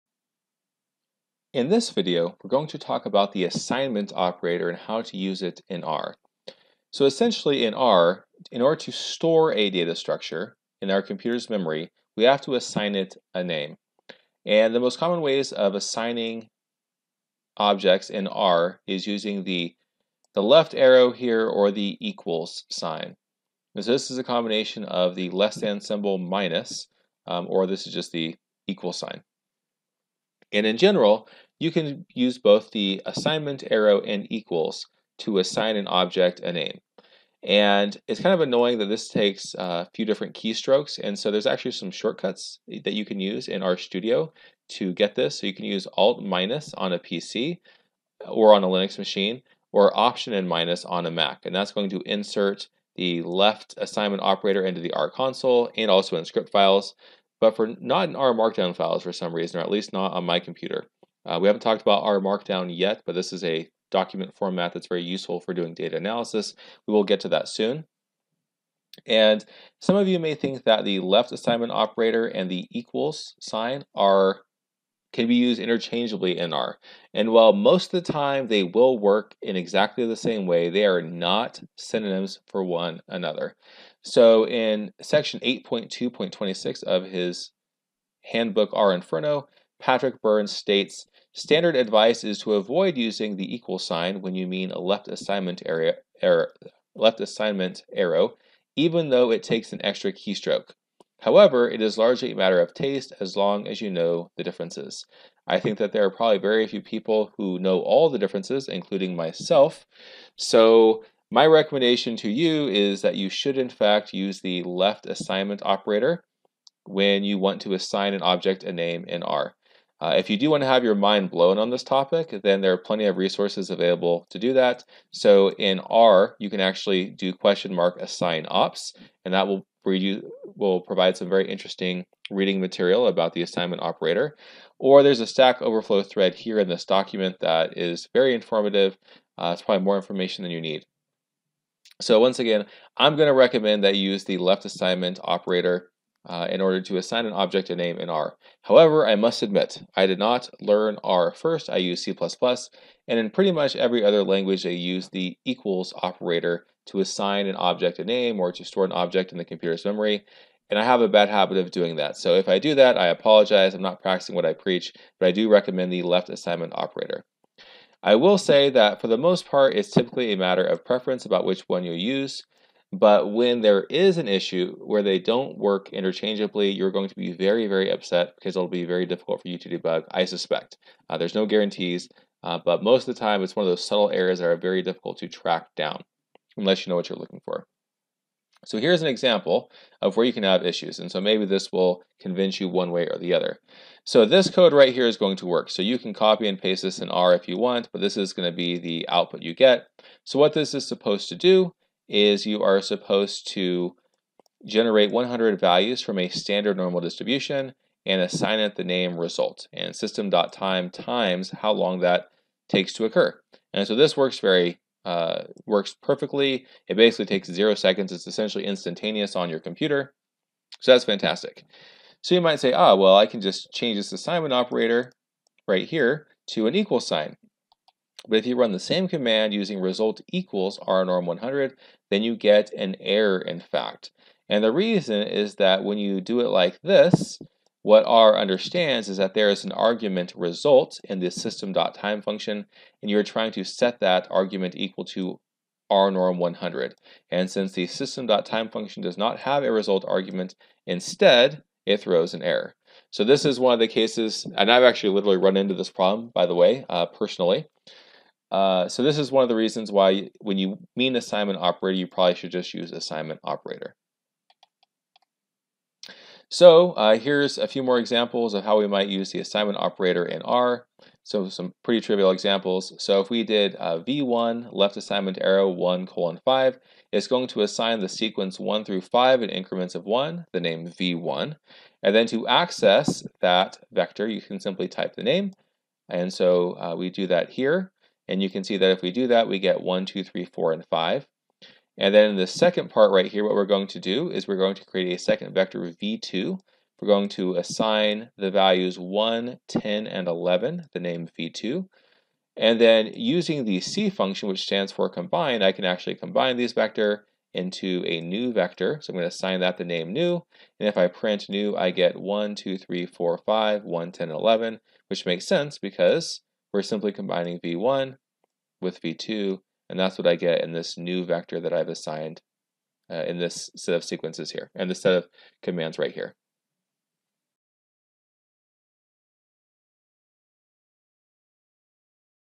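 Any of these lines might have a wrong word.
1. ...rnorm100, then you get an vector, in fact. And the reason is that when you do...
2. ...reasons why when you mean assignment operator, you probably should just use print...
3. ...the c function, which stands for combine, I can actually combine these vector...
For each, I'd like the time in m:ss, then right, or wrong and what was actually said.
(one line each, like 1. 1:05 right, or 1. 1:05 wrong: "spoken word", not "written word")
1. 3:50 wrong: "error", not "vector"
2. 4:19 wrong: "assignment", not "print"
3. 5:03 right.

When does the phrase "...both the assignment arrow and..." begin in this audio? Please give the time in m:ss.
0:32.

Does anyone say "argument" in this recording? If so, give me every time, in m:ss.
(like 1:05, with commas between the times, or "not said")
3:59, 4:04, 4:10.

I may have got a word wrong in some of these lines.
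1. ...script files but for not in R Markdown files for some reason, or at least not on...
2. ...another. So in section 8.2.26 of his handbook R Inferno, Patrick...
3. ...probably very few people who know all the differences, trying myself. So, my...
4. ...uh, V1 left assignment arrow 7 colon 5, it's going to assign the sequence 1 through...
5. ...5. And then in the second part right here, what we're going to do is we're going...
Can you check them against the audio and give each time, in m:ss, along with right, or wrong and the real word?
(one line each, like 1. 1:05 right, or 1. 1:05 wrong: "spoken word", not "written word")
1. 0:56 right
2. 1:23 right
3. 1:46 wrong: "including", not "trying"
4. 4:33 wrong: "1", not "7"
5. 4:50 right.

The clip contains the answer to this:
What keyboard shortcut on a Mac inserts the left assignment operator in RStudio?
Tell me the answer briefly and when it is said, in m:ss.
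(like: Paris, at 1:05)
Option and minus, at 0:49.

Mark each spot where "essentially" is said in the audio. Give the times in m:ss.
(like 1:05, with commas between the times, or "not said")
0:07, 3:38.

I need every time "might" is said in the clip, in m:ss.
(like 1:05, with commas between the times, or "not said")
3:42, 4:28.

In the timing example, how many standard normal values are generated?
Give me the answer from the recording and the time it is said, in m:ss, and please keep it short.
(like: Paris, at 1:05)
100, at 3:25.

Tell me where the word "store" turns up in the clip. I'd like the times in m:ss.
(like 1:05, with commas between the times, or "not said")
0:08, 2:38.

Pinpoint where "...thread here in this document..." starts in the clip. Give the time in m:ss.
2:16.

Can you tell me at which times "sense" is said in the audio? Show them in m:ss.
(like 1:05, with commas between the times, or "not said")
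5:15.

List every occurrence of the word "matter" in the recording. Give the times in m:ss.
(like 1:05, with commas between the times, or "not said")
1:42, 2:50.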